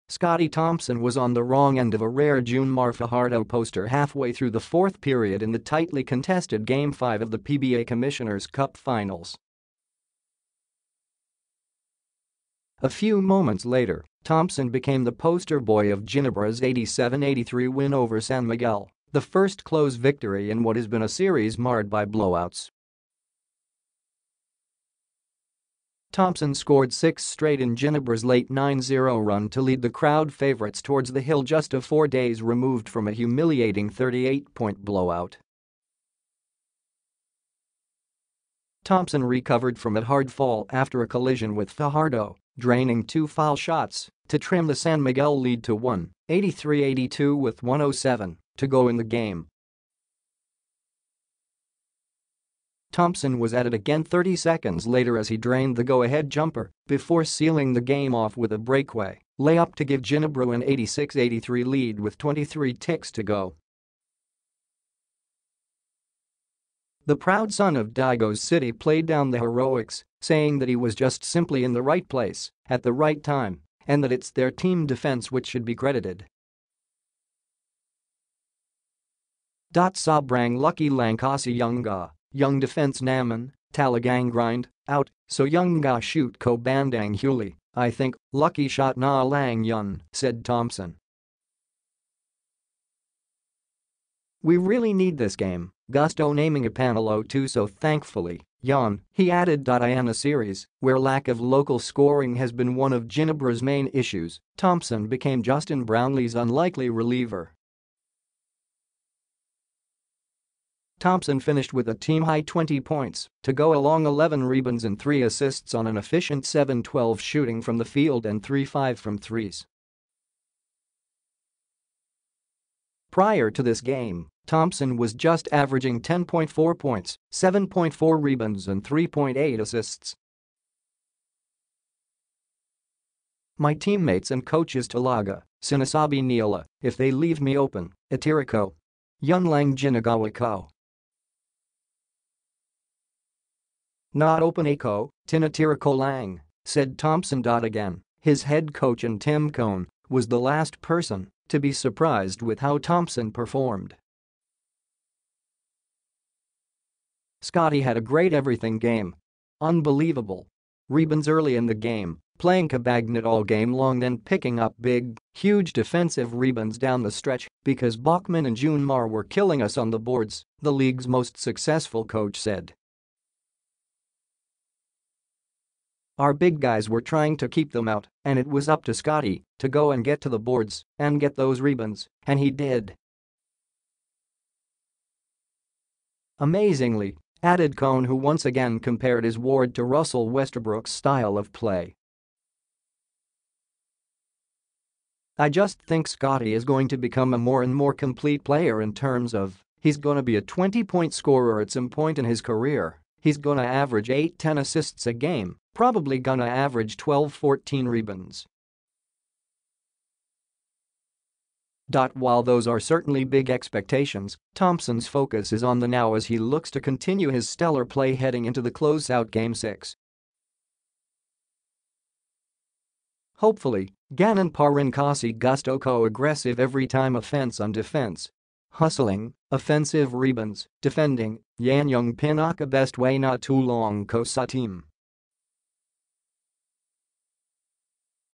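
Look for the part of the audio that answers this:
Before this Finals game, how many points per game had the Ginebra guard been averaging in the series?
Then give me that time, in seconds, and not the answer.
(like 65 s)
126 s.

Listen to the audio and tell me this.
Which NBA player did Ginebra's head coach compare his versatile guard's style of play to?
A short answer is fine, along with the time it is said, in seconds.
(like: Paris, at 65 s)
Russell Westbrook, at 189 s.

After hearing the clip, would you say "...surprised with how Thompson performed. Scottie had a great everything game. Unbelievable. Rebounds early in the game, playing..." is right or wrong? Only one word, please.
right.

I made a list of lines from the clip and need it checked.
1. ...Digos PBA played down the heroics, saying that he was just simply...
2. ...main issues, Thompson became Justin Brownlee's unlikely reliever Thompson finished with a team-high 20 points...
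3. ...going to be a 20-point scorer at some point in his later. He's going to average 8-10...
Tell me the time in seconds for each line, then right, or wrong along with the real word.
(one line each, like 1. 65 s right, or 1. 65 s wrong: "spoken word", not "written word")
1. 67 s wrong: "City", not "PBA"
2. 103 s right
3. 199 s wrong: "career", not "later".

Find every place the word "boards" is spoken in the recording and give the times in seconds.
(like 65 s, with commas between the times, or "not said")
169 s, 180 s.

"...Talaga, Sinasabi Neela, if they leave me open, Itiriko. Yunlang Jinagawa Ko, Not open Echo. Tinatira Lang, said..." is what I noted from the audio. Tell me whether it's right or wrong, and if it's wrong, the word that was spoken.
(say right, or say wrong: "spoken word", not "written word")
right.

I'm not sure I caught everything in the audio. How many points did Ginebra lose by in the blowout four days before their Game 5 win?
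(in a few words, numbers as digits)
38.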